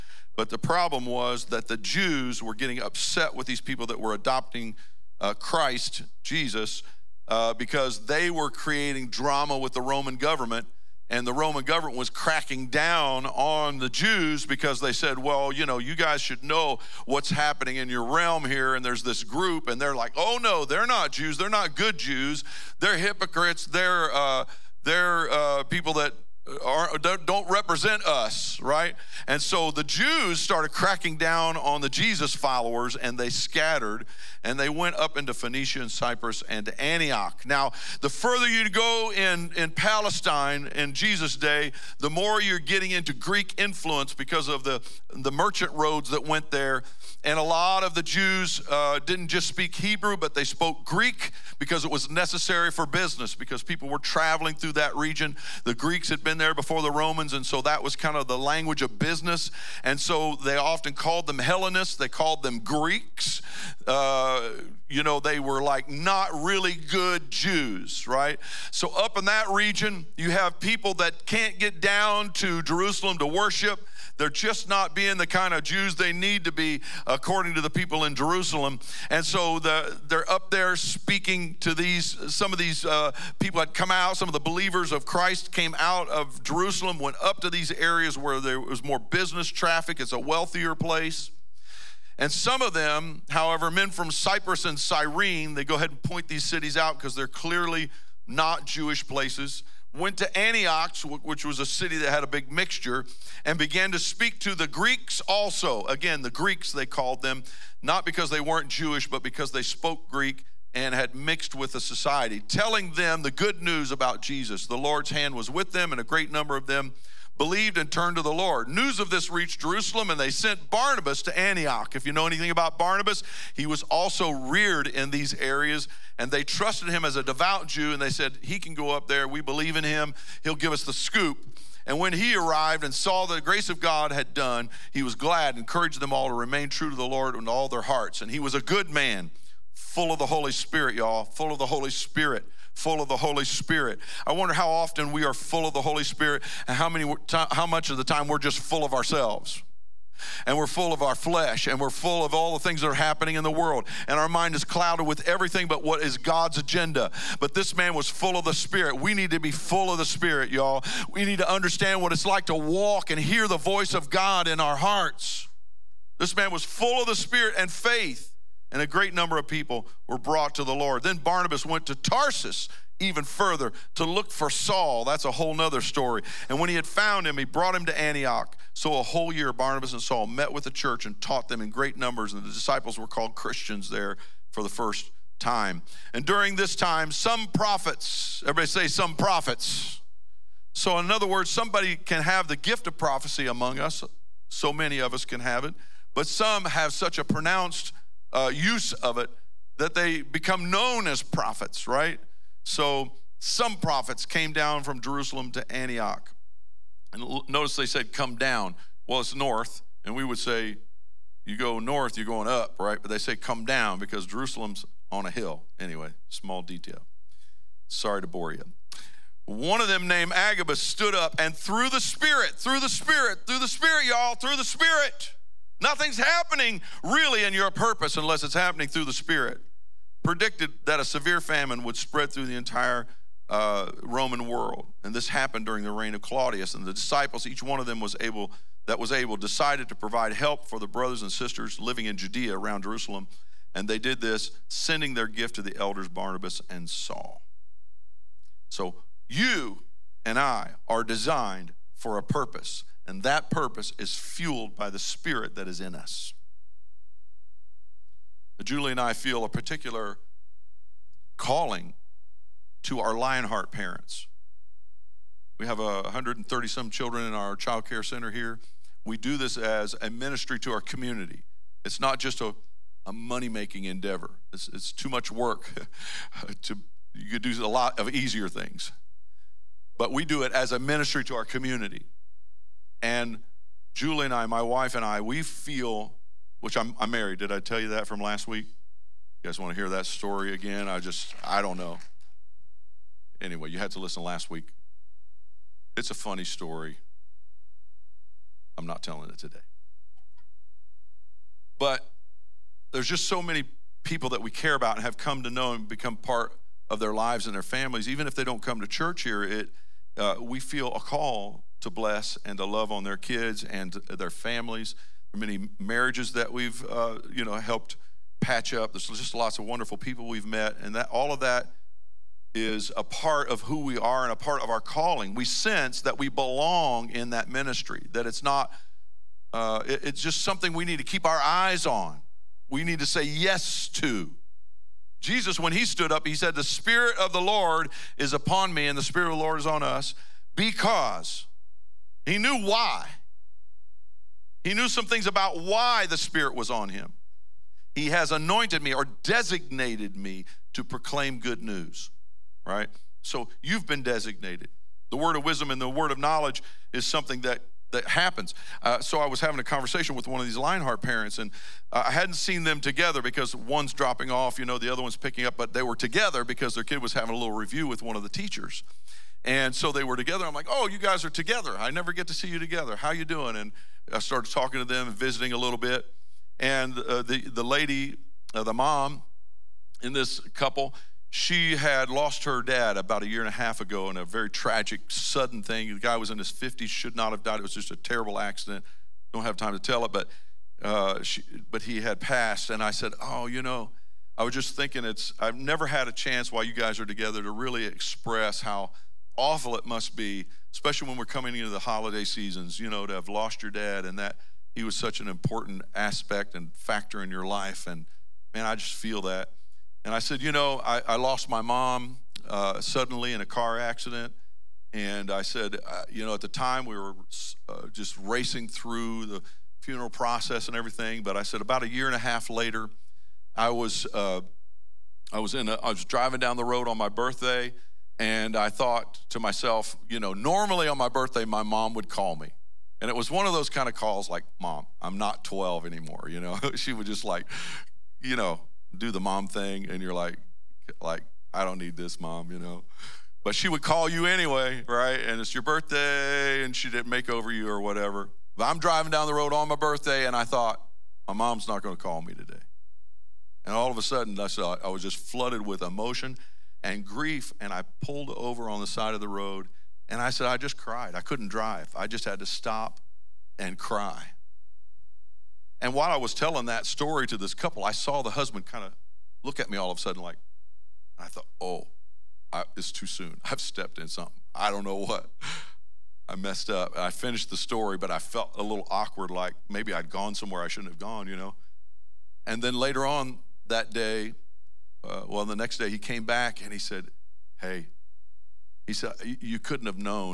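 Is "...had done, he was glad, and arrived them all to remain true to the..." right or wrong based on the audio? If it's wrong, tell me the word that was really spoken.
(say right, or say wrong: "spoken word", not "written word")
wrong: "encouraged", not "arrived".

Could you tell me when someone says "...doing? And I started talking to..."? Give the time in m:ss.
6:13.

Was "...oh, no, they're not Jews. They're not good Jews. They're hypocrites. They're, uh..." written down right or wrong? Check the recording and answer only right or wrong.
right.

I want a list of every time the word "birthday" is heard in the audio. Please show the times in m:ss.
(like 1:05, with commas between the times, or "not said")
7:07, 7:11, 7:25, 7:29.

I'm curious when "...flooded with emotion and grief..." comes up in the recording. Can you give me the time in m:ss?
7:35.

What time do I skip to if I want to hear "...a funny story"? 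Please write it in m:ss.
4:56.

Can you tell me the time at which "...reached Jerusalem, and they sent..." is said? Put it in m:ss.
1:59.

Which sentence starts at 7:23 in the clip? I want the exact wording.
But she would call you anyway, right?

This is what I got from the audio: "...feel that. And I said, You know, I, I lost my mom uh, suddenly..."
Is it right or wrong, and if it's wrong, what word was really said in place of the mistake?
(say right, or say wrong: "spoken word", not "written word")
right.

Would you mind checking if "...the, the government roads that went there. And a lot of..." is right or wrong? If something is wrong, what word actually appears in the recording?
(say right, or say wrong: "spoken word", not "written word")
wrong: "merchant", not "government".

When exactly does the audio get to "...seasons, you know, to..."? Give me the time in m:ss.
6:42.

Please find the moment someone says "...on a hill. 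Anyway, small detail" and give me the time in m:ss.
3:35.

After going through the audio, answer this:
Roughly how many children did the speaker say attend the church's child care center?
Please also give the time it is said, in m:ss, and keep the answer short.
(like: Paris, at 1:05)
130, at 4:26.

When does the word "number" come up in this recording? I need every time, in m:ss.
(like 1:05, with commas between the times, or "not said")
1:56, 2:49, 3:01.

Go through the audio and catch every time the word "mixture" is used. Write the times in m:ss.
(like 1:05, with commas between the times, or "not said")
1:42.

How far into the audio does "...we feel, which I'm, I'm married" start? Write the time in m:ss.
4:45.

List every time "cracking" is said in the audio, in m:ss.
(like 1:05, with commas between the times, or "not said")
0:12, 0:30.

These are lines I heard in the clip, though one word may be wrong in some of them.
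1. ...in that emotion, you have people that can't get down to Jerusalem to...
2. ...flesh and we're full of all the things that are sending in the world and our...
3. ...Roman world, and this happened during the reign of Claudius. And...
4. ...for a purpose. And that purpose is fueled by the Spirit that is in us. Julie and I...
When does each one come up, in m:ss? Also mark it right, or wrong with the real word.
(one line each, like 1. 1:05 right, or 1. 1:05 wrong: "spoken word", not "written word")
1. 1:09 wrong: "region", not "emotion"
2. 2:31 wrong: "happening", not "sending"
3. 3:54 right
4. 4:11 right.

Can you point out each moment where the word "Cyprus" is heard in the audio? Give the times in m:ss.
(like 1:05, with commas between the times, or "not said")
0:35, 1:34.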